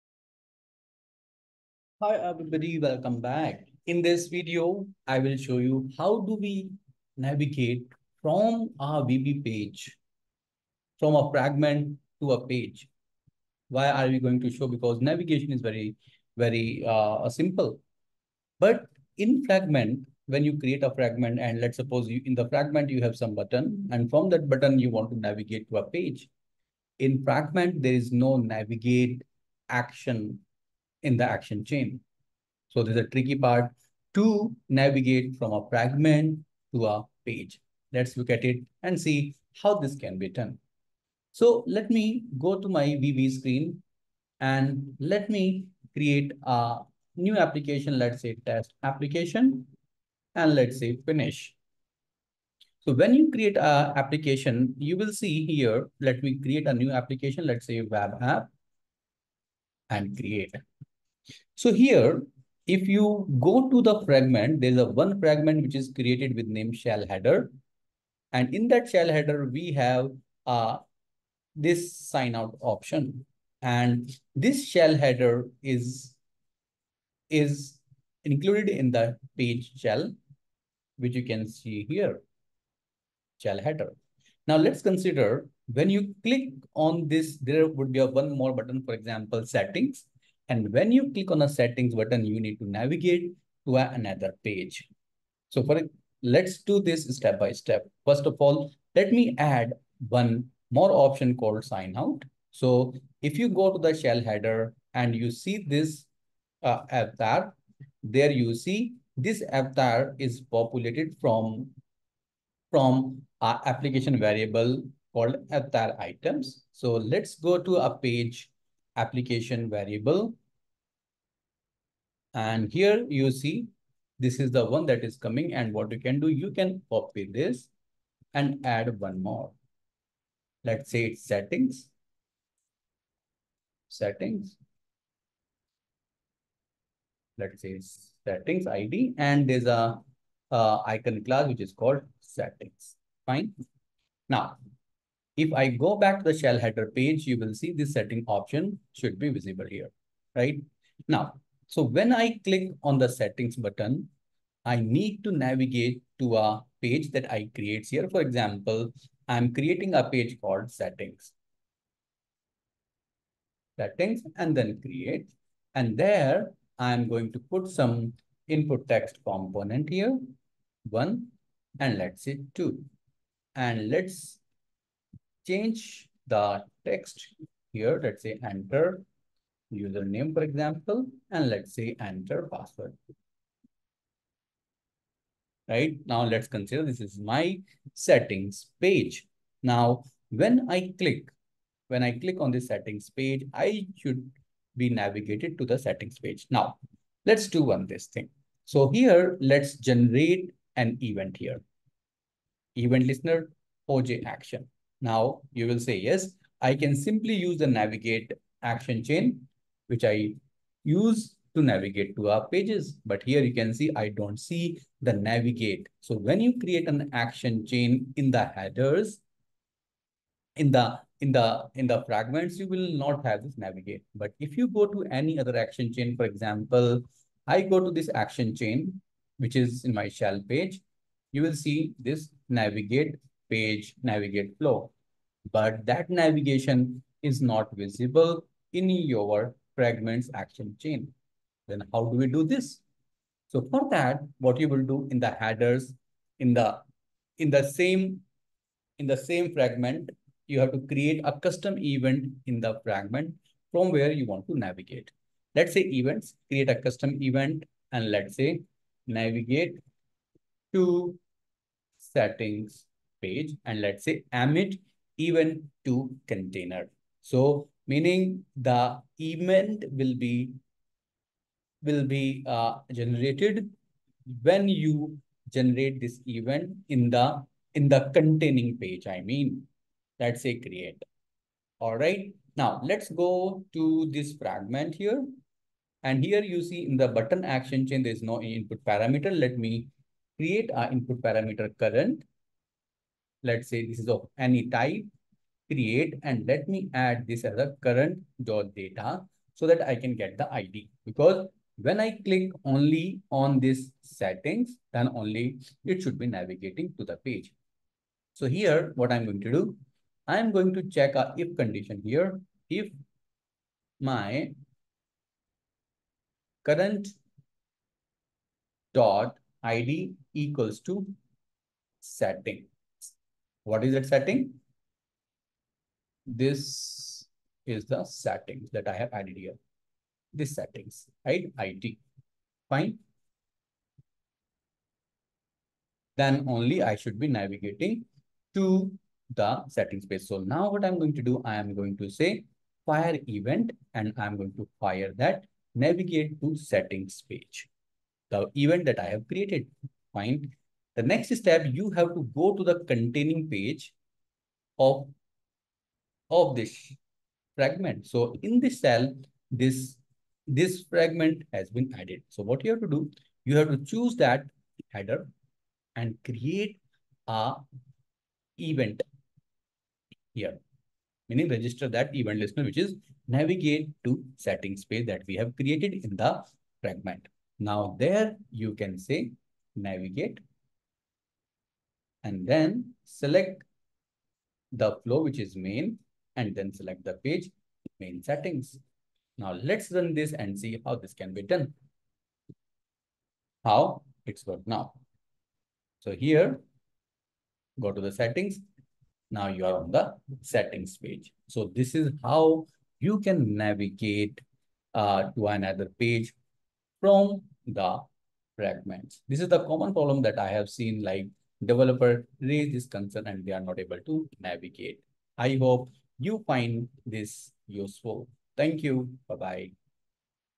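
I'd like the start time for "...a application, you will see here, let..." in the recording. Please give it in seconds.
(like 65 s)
53 s.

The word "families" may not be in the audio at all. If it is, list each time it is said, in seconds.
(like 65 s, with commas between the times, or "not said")
not said.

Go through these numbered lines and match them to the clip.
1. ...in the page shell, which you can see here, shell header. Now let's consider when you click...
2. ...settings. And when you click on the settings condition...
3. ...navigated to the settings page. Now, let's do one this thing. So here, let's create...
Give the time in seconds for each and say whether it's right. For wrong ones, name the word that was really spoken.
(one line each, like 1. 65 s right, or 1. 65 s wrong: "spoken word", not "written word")
1. 78 s right
2. 89 s wrong: "button", not "condition"
3. 194 s wrong: "generate", not "create".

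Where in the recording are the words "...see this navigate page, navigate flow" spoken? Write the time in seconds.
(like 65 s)
231 s.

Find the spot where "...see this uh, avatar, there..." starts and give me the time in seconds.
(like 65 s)
105 s.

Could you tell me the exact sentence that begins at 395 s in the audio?
So here, go to the settings.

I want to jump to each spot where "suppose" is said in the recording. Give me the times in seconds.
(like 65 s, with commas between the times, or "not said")
21 s.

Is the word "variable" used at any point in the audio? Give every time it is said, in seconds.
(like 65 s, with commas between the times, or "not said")
114 s, 119 s.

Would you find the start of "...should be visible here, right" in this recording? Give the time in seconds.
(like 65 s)
148 s.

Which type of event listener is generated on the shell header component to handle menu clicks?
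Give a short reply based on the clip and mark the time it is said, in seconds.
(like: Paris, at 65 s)
OJ action, at 203 s.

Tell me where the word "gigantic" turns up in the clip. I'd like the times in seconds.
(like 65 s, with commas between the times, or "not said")
not said.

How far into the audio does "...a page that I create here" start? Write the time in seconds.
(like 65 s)
156 s.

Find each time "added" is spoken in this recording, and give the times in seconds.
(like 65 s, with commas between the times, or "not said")
329 s, 361 s.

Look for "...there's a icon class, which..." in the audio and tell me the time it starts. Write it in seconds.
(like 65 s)
139 s.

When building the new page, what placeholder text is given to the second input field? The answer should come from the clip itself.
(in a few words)
enter password.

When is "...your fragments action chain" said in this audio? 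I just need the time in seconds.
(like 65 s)
238 s.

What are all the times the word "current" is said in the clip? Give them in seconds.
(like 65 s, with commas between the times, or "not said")
291 s, 297 s, 316 s.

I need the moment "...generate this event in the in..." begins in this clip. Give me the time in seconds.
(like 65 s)
275 s.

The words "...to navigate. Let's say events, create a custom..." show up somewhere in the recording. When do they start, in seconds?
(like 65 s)
254 s.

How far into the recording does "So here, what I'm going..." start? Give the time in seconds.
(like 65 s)
308 s.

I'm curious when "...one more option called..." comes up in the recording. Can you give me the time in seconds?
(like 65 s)
100 s.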